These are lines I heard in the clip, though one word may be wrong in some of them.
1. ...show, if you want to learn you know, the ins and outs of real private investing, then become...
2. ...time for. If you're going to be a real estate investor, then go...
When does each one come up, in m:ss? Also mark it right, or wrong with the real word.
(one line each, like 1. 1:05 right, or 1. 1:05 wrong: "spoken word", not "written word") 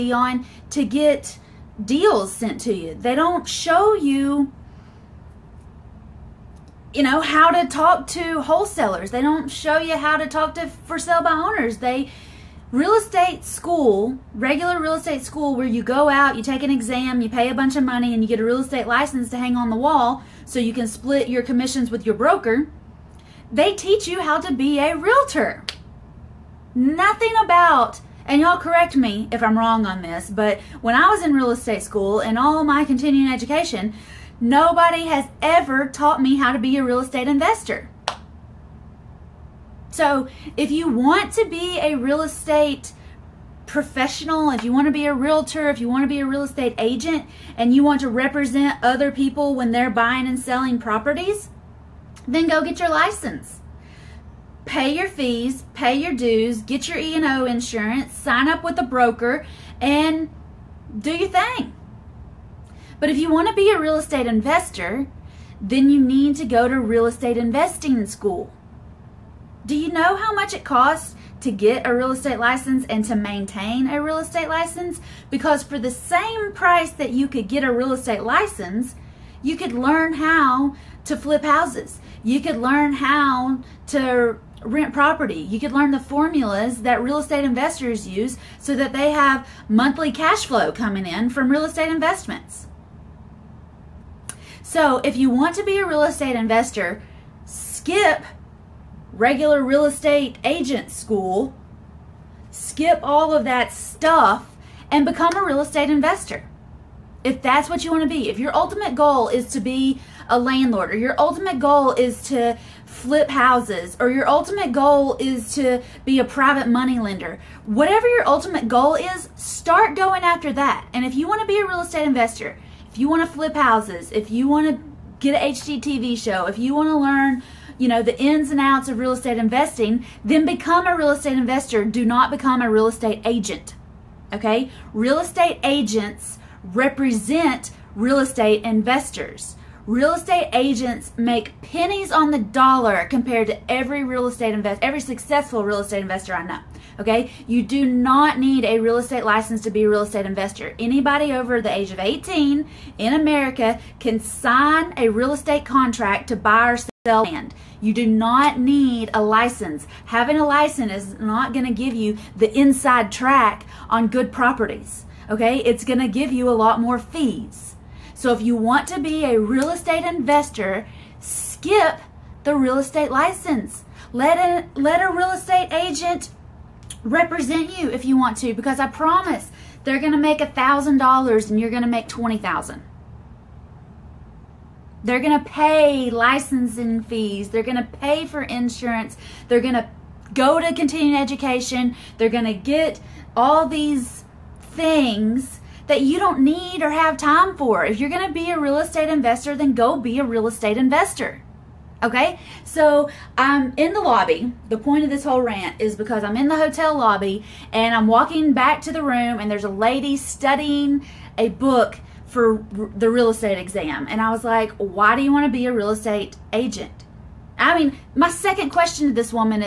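1. 2:06 wrong: "estate", not "private"
2. 3:17 right.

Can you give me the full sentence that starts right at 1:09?
Do you know how much it costs to get a real estate license and to maintain a real estate license?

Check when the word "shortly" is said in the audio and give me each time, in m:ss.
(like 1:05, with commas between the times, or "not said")
not said.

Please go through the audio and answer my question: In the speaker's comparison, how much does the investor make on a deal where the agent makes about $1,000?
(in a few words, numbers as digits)
$20,000.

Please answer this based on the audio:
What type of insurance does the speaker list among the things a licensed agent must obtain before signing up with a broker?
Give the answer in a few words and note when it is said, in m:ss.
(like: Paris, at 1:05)
E&O insurance, at 0:56.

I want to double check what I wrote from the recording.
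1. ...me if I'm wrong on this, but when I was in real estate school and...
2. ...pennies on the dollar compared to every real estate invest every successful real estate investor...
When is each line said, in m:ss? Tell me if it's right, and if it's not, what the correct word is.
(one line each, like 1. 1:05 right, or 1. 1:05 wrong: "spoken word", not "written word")
1. 0:28 right
2. 2:21 right.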